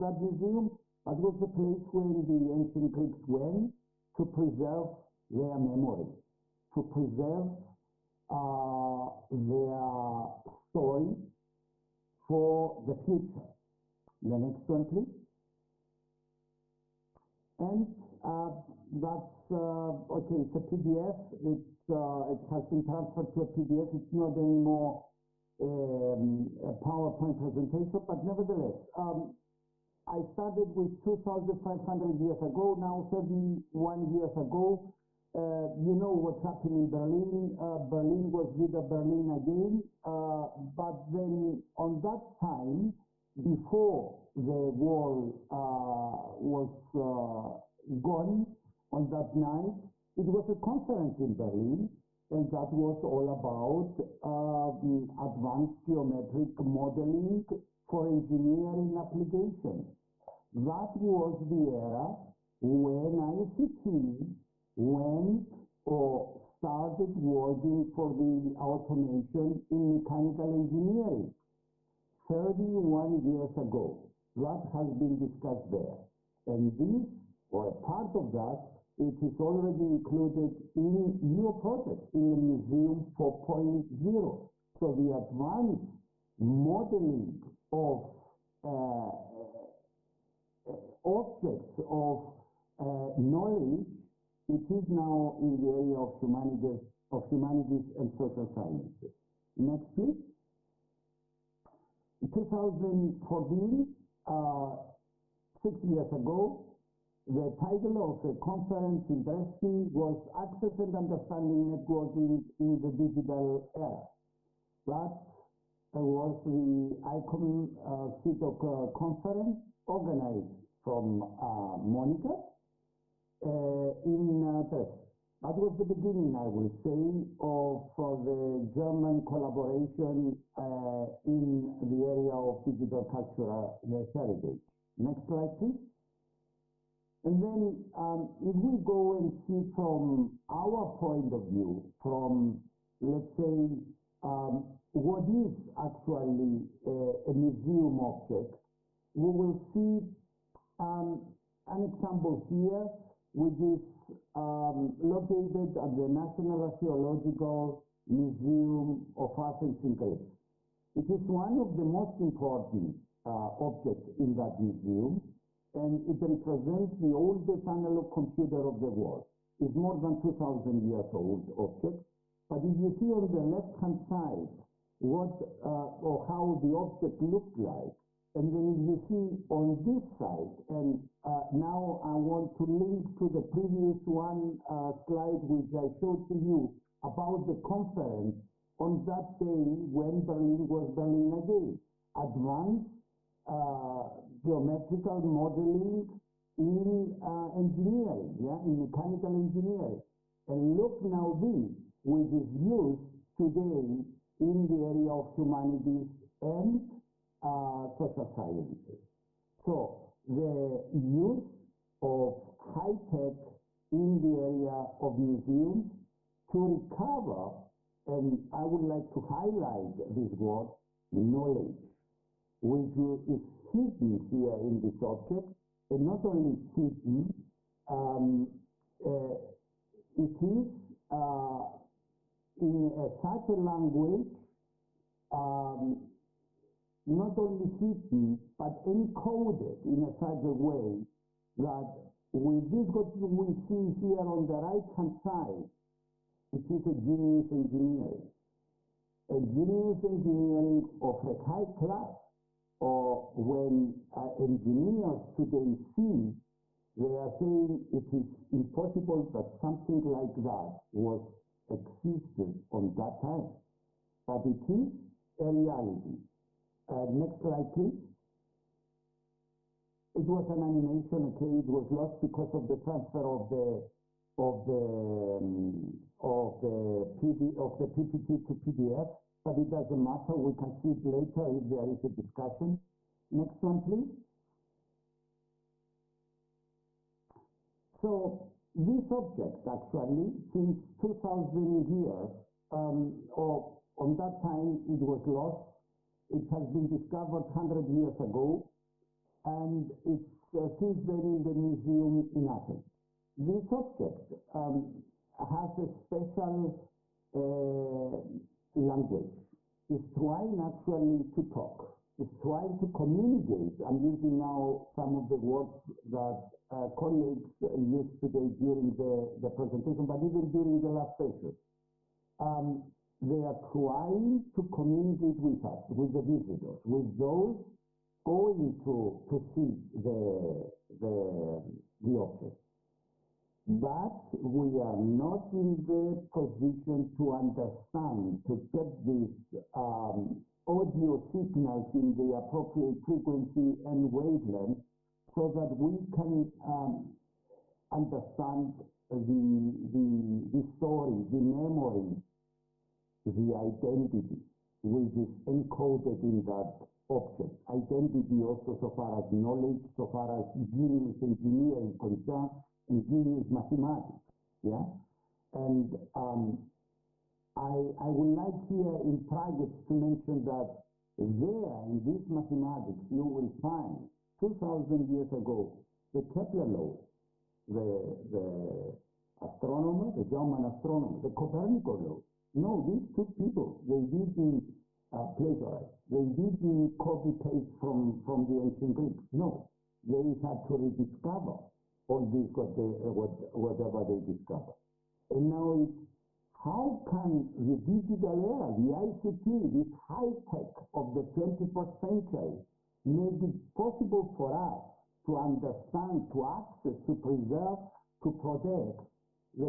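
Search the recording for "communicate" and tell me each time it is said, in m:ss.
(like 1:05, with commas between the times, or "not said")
5:12, 5:24.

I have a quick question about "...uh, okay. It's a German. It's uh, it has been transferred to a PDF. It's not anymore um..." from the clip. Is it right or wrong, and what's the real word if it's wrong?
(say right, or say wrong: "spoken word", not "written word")
wrong: "PDF", not "German".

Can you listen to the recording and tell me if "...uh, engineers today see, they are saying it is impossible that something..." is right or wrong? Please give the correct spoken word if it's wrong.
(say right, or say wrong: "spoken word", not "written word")
right.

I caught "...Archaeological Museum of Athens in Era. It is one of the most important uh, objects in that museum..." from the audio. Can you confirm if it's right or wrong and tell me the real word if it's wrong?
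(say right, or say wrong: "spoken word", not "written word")
wrong: "Greece", not "Era".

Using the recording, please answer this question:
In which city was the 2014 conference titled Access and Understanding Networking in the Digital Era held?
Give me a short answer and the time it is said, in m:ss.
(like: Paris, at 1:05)
Dresden, at 1:49.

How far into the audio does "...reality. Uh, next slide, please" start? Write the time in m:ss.
4:25.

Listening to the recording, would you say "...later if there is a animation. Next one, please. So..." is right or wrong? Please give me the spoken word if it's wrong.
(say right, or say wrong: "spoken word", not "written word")
wrong: "discussion", not "animation".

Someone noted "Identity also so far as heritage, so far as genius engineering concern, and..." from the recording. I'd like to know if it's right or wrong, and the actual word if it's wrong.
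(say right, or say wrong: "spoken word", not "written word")
wrong: "knowledge", not "heritage".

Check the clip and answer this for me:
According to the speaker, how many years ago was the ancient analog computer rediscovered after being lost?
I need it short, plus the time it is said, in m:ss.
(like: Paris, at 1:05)
100, at 4:57.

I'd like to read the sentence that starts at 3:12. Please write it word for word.
Advanced uh, geometrical modeling in uh, engineering, yeah, in mechanical engineering.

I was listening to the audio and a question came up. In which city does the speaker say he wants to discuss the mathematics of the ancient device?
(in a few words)
Prague.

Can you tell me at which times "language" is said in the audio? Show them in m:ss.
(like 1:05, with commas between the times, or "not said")
3:53, 5:08.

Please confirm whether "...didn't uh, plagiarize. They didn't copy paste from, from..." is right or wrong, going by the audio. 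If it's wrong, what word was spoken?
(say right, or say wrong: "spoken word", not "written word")
right.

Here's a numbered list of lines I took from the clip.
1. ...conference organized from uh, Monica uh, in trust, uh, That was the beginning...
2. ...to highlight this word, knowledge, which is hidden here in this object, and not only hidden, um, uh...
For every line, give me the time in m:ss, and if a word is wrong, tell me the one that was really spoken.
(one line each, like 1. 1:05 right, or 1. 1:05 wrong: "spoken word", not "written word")
1. 1:58 right
2. 3:39 right.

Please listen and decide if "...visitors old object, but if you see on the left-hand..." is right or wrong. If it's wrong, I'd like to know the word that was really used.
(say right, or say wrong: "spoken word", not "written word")
wrong: "years", not "visitors".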